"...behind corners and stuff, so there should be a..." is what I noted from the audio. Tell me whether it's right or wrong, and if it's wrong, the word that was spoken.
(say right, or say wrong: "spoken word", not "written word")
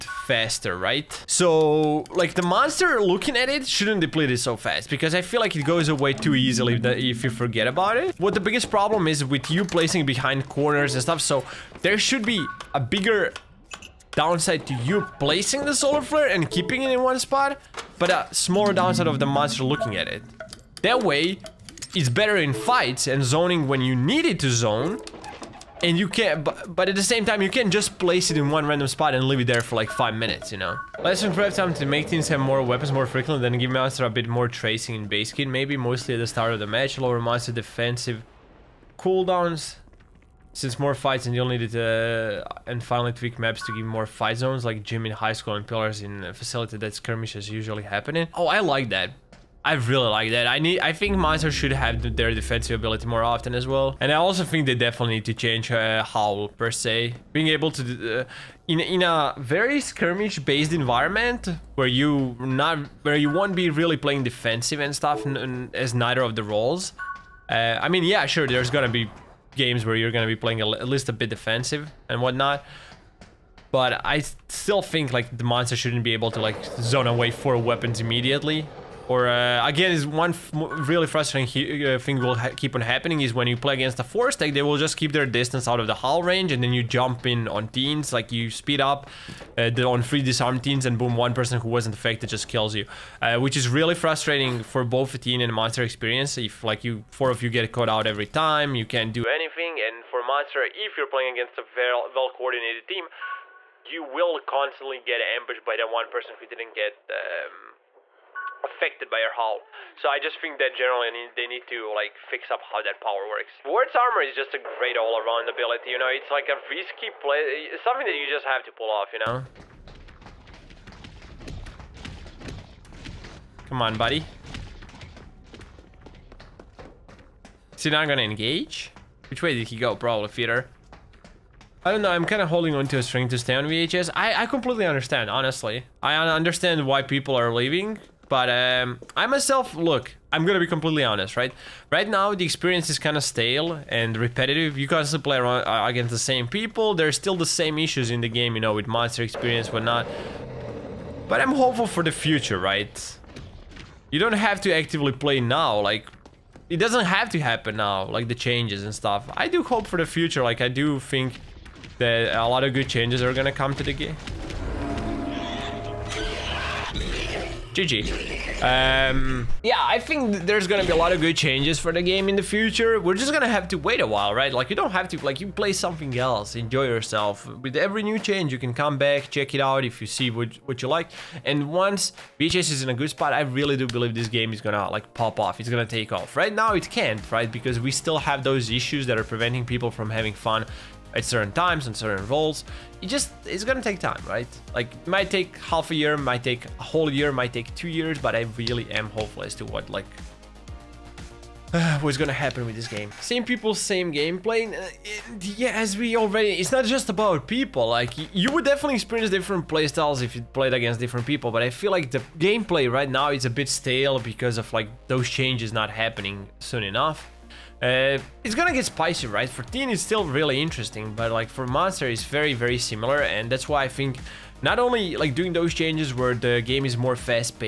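right.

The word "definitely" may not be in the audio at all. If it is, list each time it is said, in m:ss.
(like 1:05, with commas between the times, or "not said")
0:54, 3:28.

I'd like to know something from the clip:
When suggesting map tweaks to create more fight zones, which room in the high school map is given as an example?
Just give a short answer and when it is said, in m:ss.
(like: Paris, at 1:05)
gym, at 0:44.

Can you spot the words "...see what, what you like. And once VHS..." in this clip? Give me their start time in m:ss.
3:00.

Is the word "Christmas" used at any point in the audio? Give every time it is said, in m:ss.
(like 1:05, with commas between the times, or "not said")
not said.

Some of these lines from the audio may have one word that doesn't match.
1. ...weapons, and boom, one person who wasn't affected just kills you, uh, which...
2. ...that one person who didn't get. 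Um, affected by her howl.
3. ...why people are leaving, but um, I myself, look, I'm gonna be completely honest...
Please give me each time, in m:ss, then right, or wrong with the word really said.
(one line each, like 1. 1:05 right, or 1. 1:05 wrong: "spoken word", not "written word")
1. 1:30 wrong: "teens", not "weapons"
2. 1:45 right
3. 2:16 right.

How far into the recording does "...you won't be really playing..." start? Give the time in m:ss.
1:03.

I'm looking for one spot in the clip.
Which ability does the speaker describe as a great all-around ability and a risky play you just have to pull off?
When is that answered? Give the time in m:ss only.
1:53.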